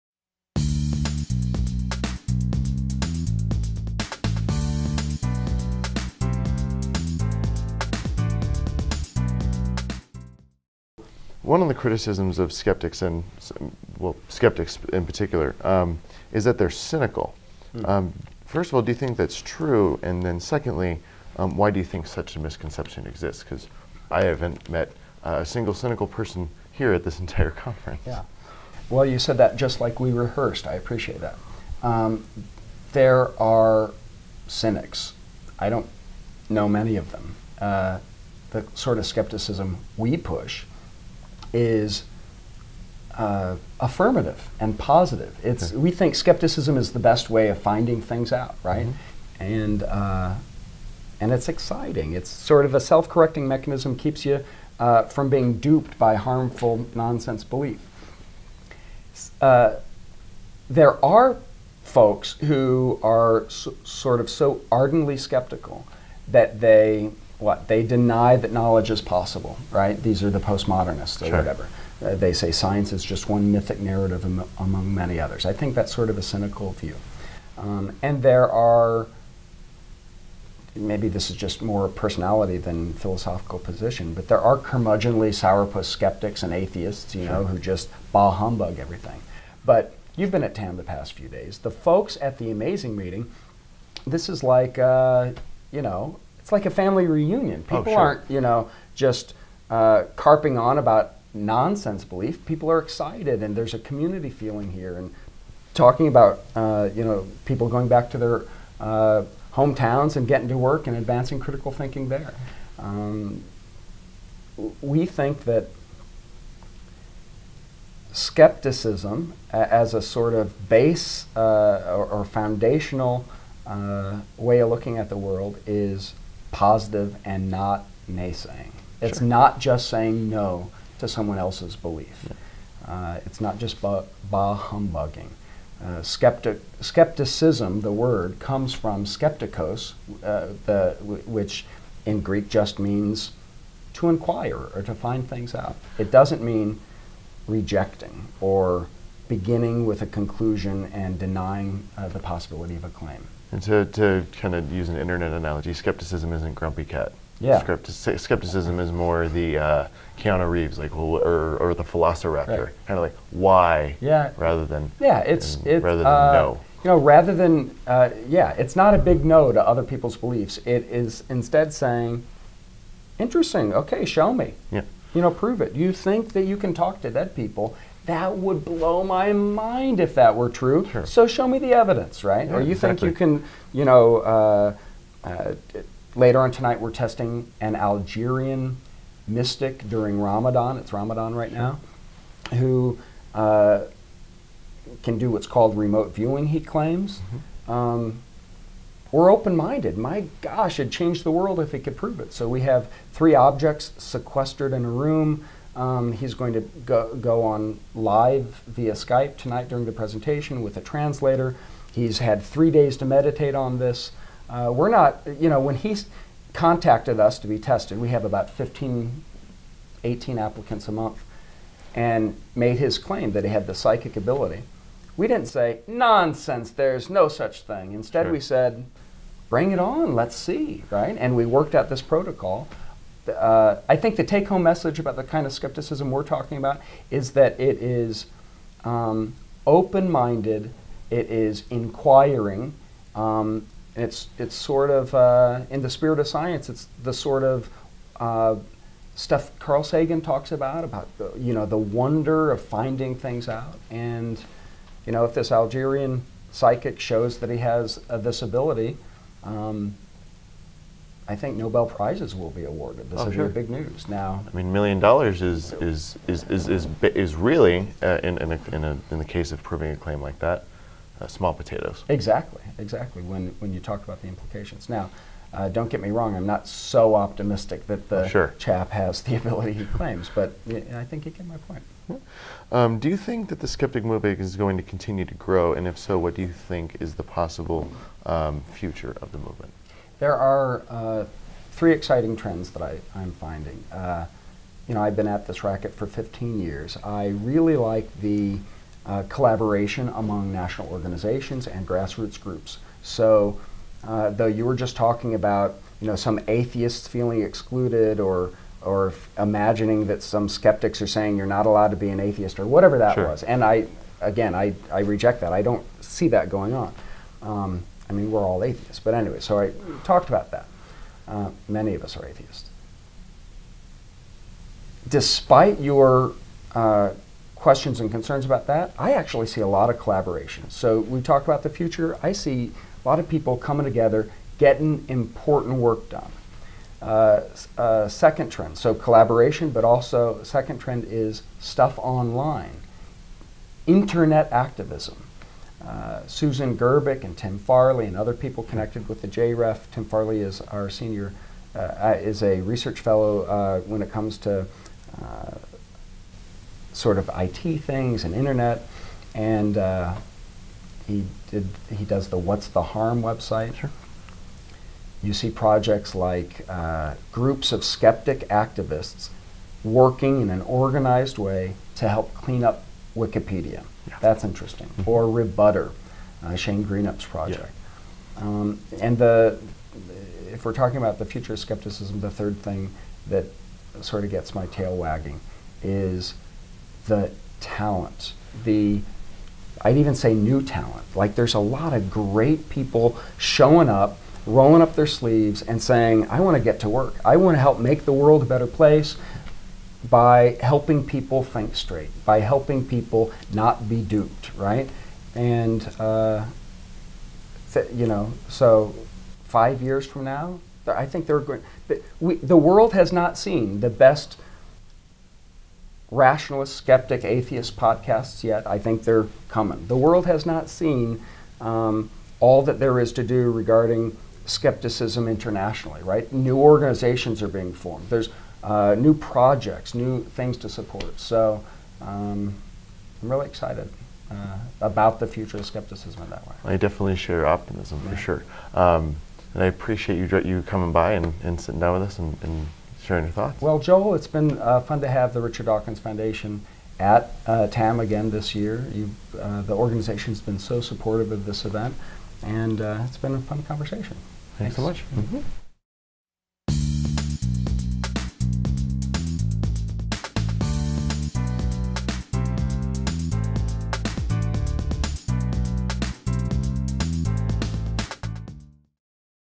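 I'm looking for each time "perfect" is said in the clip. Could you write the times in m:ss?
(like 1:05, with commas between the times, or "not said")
not said.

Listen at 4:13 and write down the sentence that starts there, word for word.
And, you know, if this Algerian psychic shows that he has uh, this ability, um, I think Nobel prizes will be awarded.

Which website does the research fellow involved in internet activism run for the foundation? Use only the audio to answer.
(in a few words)
What's the Harm.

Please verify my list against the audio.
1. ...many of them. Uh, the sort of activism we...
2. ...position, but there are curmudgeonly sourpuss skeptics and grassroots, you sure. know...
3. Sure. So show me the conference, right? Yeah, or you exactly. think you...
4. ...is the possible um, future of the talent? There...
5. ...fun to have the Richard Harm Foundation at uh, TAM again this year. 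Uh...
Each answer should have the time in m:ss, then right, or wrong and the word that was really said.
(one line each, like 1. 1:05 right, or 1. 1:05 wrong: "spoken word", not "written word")
1. 0:36 wrong: "skepticism", not "activism"
2. 1:23 wrong: "atheists", not "grassroots"
3. 3:00 wrong: "evidence", not "conference"
4. 4:46 wrong: "movement", not "talent"
5. 7:24 wrong: "Dawkins", not "Harm".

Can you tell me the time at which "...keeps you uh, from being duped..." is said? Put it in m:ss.
0:53.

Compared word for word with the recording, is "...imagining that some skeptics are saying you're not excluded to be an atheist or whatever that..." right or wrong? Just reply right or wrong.
wrong.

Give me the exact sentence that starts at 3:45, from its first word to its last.
We didn't say, nonsense, there's no such thing.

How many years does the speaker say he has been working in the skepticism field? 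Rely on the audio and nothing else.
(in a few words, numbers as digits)
15.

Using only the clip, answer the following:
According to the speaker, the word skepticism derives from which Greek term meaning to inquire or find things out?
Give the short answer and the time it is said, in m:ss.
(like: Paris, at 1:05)
skeptikos, at 2:19.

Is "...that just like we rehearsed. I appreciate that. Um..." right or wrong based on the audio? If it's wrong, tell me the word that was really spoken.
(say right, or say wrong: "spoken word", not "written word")
right.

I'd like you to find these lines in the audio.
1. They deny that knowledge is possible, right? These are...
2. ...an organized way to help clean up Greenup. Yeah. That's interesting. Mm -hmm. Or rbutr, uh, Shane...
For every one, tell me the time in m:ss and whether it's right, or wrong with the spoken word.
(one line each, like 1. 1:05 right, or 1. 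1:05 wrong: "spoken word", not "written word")
1. 1:07 right
2. 6:10 wrong: "Wikipedia", not "Greenup".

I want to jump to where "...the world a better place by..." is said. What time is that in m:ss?
6:38.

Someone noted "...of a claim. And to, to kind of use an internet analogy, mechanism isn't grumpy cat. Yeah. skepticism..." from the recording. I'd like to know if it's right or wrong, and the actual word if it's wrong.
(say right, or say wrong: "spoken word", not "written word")
wrong: "skepticism", not "mechanism".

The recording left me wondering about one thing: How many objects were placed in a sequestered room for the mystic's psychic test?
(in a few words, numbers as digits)
3.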